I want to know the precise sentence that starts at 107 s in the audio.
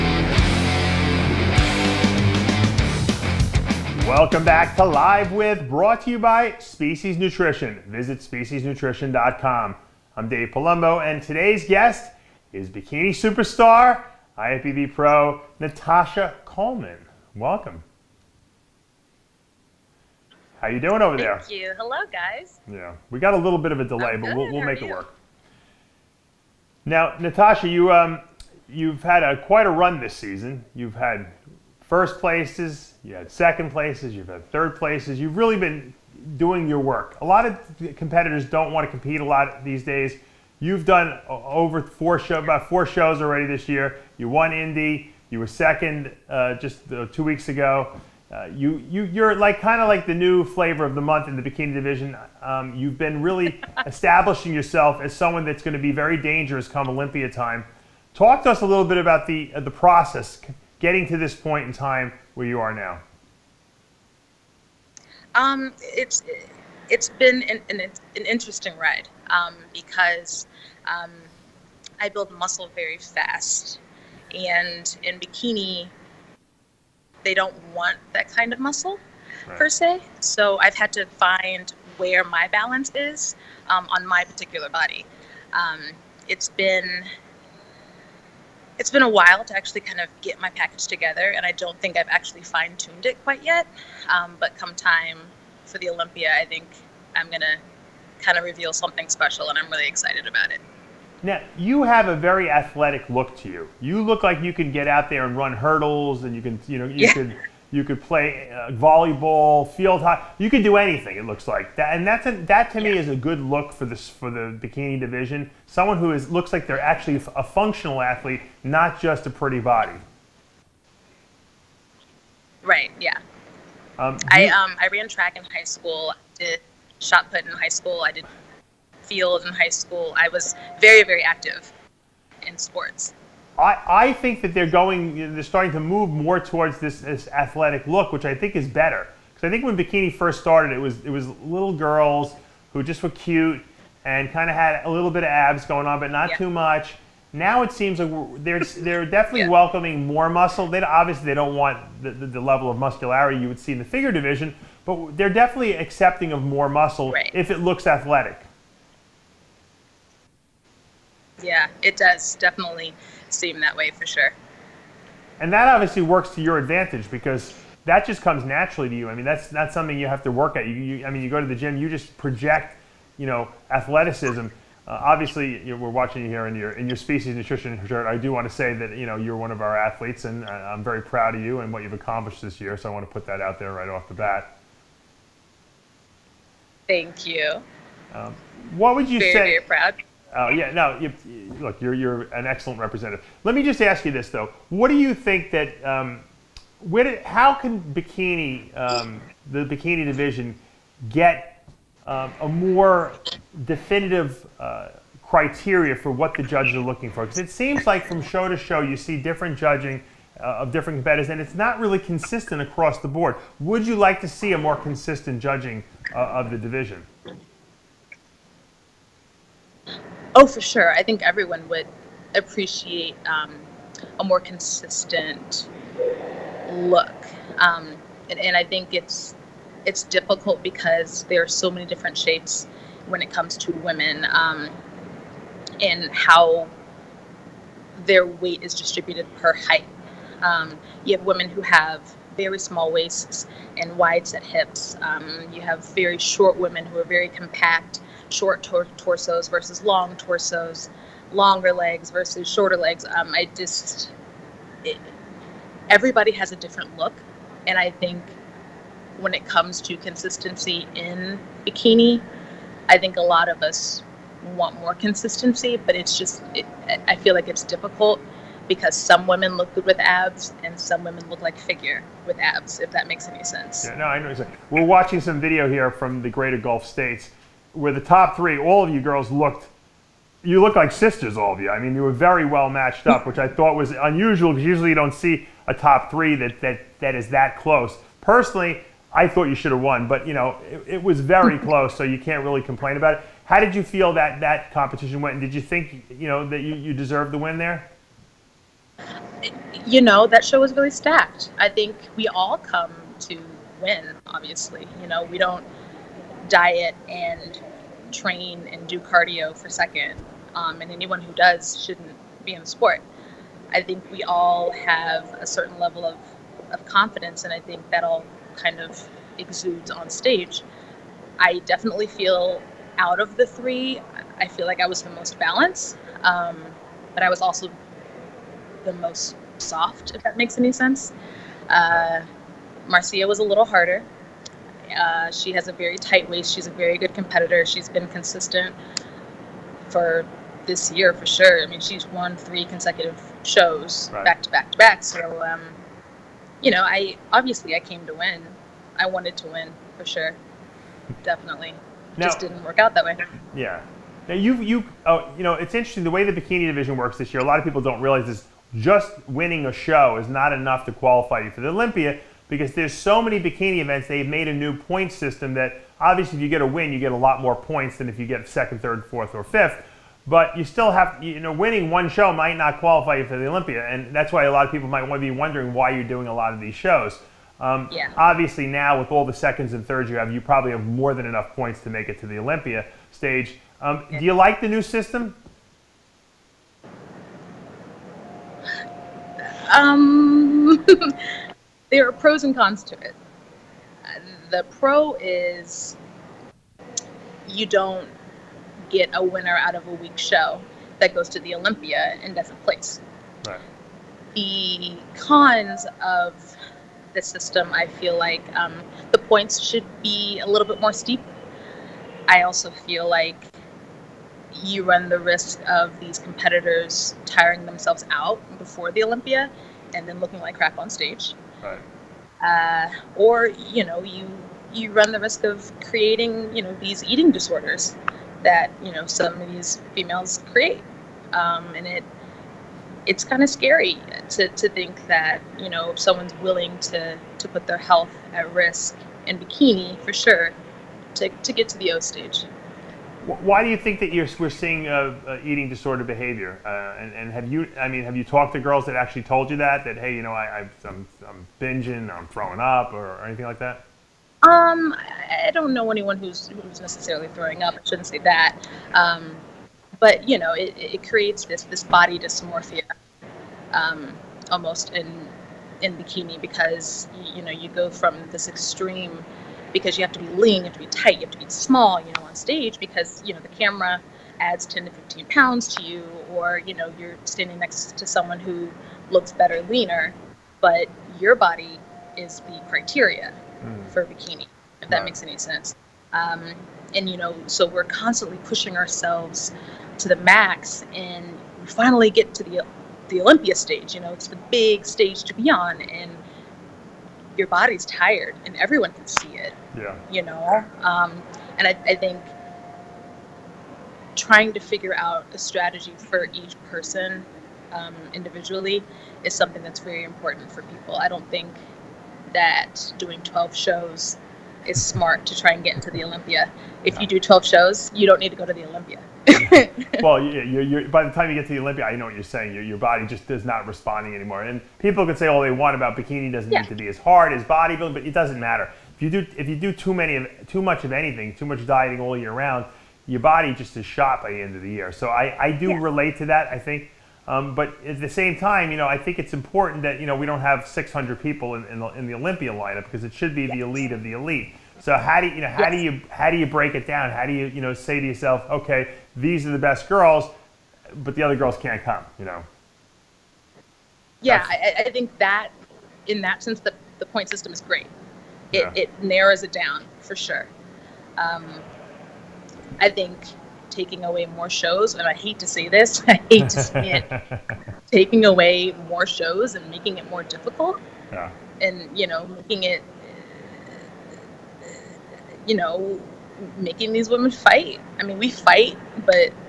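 can you could play uh, volleyball, field hockey.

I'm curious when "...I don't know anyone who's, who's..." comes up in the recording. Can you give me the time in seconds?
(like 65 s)
455 s.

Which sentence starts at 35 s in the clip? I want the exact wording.
You've really been doing your work.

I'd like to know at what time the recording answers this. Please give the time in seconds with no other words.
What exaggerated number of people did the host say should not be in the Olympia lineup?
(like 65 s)
540 s.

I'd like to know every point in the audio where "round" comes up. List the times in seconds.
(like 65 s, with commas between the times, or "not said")
532 s.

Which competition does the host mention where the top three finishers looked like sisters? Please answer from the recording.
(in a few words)
Greater Gulf States.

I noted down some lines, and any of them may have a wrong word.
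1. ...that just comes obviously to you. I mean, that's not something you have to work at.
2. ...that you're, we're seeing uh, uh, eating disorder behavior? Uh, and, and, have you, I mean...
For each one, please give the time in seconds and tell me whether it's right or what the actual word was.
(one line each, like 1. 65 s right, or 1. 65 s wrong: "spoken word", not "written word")
1. 167 s wrong: "naturally", not "obviously"
2. 443 s right.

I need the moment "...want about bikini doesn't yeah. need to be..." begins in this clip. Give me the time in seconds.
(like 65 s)
525 s.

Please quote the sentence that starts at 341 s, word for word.
I mean, she's won three consecutive shows right.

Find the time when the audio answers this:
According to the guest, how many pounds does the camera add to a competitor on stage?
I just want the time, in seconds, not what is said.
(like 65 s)
474 s.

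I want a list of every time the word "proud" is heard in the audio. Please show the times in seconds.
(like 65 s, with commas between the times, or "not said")
181 s, 189 s.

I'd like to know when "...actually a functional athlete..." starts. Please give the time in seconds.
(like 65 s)
116 s.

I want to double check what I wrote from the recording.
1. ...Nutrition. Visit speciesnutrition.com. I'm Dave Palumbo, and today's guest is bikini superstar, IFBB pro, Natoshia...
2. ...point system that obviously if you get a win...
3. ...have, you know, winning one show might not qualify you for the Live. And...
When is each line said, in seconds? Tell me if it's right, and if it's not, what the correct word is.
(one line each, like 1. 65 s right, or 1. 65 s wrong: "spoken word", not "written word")
1. 7 s right
2. 364 s right
3. 370 s wrong: "Olympia", not "Live".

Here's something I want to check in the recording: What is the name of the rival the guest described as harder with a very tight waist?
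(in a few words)
Marcia.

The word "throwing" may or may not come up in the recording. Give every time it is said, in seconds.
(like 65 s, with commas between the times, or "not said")
452 s, 457 s.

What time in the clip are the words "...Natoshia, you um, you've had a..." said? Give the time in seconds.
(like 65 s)
27 s.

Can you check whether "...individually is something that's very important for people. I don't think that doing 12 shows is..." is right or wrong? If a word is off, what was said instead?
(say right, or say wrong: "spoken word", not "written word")
right.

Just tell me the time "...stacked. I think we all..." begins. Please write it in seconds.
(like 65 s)
300 s.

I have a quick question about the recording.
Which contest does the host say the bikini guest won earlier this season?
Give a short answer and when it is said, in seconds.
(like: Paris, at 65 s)
Indy, at 44 s.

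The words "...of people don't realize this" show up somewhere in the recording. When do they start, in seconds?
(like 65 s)
357 s.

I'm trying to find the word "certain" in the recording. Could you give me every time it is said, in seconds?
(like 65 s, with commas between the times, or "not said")
315 s.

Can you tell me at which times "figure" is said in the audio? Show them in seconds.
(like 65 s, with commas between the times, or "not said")
153 s, 271 s, 504 s.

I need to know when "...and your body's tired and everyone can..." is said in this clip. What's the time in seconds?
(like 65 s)
495 s.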